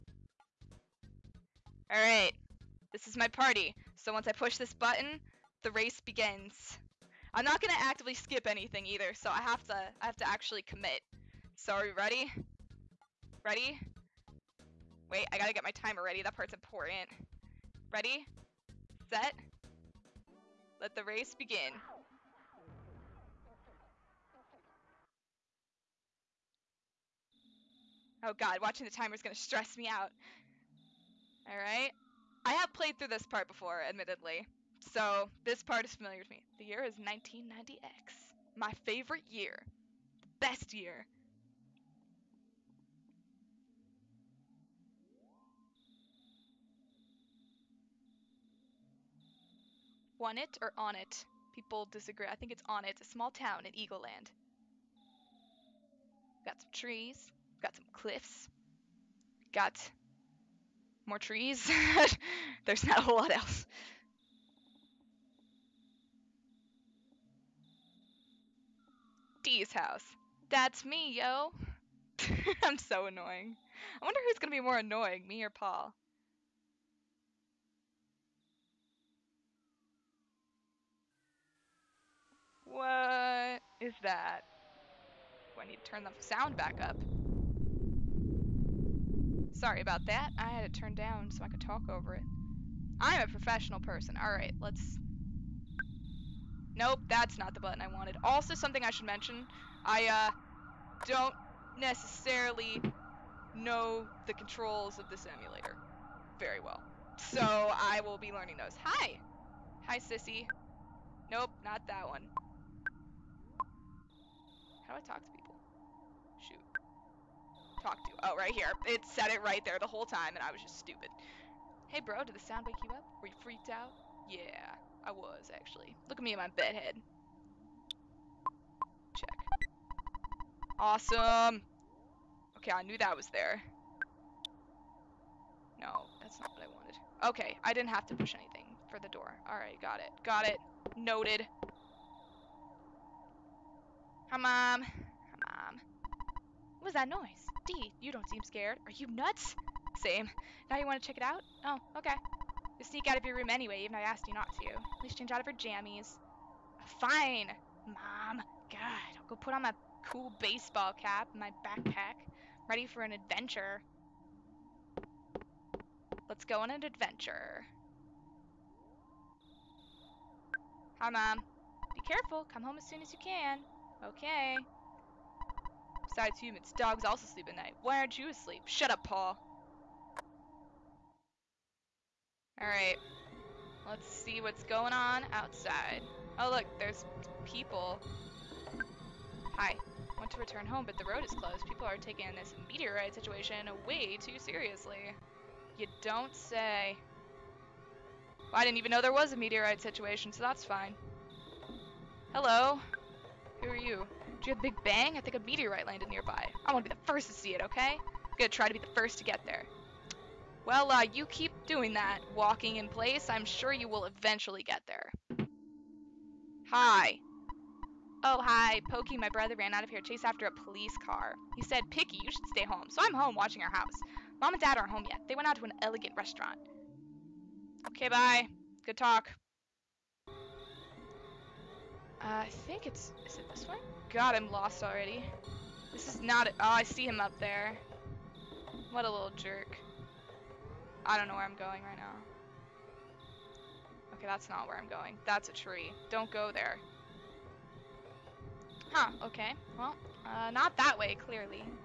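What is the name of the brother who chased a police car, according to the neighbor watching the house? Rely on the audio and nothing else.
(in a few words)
Pokey.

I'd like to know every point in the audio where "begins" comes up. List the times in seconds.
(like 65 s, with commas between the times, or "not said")
6 s, 21 s.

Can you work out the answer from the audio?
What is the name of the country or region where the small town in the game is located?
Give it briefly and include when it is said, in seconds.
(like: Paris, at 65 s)
Eagleland, at 53 s.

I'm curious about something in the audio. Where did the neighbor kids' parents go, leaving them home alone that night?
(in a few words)
An elegant restaurant.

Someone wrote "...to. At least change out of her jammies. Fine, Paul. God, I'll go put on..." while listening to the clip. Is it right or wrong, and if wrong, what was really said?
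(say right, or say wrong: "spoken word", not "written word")
wrong: "Mom", not "Paul".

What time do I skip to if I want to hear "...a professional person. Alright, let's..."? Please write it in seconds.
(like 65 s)
93 s.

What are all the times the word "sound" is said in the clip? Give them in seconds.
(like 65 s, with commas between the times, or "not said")
86 s, 122 s.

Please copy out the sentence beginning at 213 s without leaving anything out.
I'm sure you will eventually get there.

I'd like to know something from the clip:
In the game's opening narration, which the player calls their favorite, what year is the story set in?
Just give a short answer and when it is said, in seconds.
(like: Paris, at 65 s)
199X, at 36 s.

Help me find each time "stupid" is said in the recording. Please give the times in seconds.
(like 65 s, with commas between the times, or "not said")
120 s.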